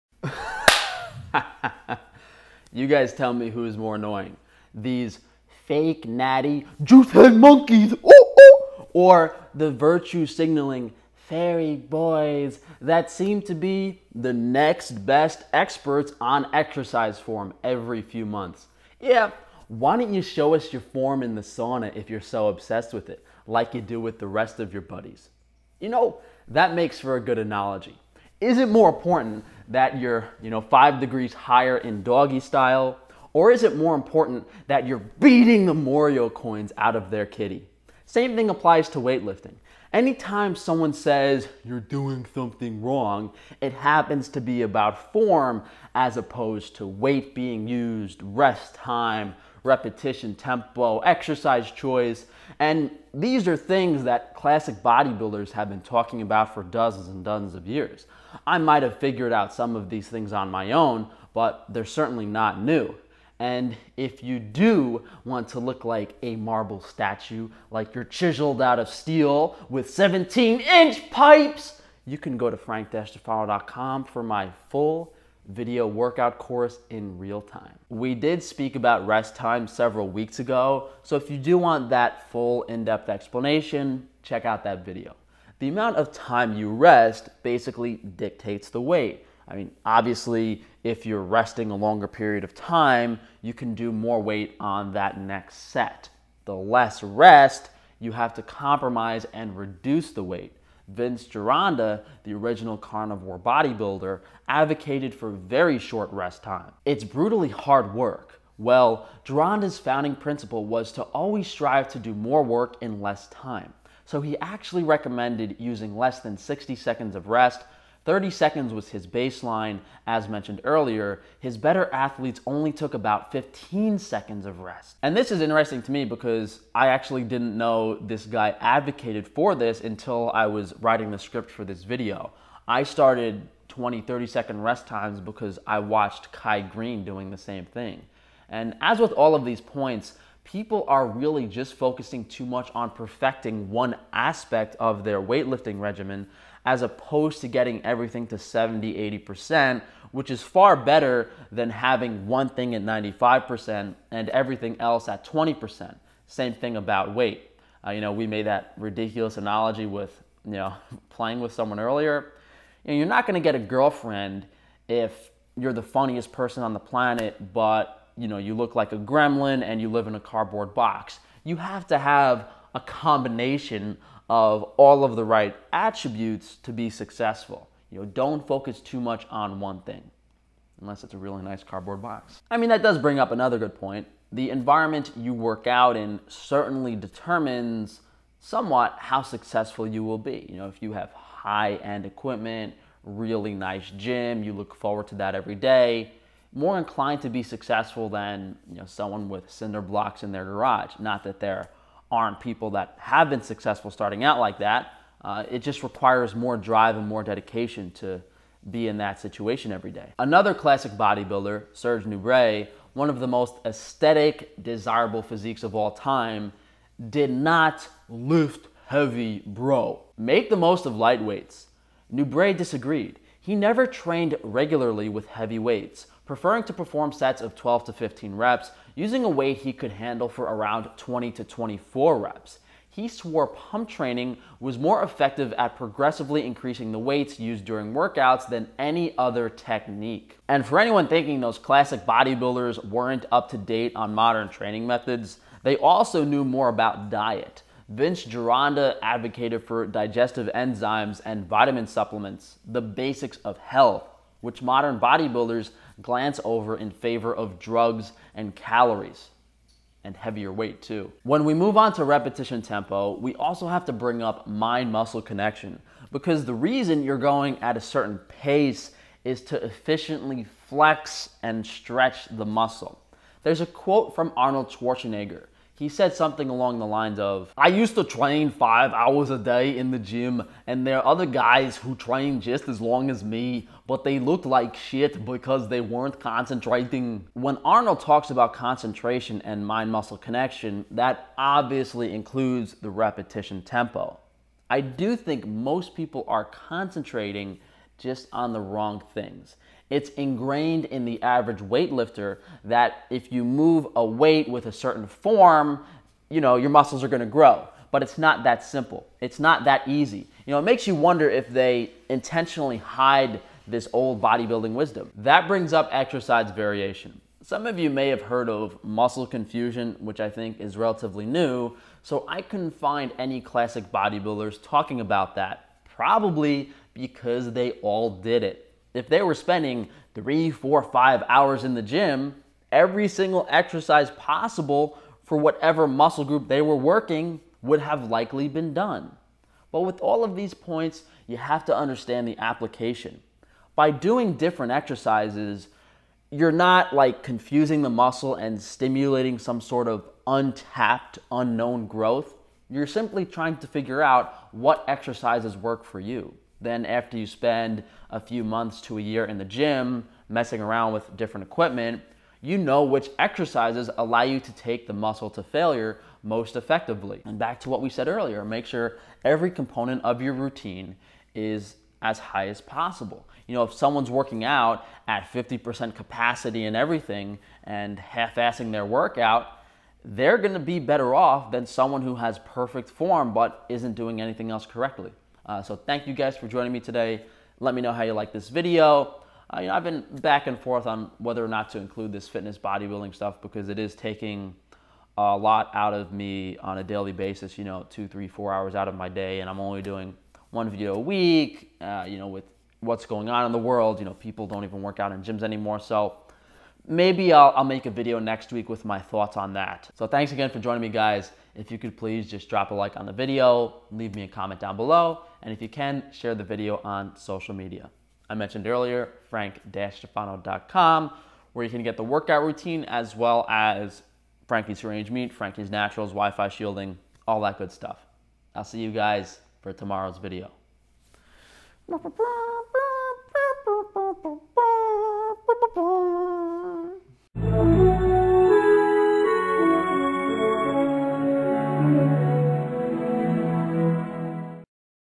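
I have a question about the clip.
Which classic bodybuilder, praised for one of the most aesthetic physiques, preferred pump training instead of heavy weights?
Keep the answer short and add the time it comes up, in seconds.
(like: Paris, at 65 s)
Serge Nubret, at 211 s.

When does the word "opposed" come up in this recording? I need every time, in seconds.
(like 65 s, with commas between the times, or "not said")
46 s, 146 s.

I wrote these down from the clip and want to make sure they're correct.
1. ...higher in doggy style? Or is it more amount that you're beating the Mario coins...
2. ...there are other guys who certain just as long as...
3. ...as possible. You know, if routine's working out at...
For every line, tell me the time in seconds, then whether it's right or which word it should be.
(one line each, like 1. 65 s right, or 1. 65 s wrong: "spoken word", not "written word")
1. 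31 s wrong: "important", not "amount"
2. 280 s wrong: "train", not "certain"
3. 372 s wrong: "someone", not "routine".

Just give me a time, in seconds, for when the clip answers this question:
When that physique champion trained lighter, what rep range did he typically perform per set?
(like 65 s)
227 s.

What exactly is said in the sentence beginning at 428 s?
I'll see you guys for tomorrow's video.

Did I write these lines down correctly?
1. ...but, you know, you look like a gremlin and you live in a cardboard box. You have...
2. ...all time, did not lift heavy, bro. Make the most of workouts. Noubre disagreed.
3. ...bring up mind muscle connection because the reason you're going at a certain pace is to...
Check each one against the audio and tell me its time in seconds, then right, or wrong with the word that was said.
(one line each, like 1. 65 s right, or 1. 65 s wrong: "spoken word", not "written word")
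1. 167 s right
2. 215 s wrong: "lightweights", not "workouts"
3. 263 s right.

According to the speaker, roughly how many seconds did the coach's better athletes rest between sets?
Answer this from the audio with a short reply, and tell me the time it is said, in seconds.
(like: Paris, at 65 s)
15 seconds, at 123 s.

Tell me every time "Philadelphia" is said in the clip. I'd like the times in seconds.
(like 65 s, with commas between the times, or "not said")
not said.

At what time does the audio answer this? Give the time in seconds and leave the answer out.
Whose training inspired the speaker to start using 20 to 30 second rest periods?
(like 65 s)
136 s.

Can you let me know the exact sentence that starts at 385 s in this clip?
Uh, so thank you guys for joining me today.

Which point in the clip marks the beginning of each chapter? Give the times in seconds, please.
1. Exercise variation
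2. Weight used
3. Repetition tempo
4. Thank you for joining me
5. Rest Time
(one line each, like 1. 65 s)
1. 315 s
2. 210 s
3. 261 s
4. 385 s
5. 77 s.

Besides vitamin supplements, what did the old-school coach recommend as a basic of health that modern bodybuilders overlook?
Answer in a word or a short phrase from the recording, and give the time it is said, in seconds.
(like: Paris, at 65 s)
Digestive enzymes, at 249 s.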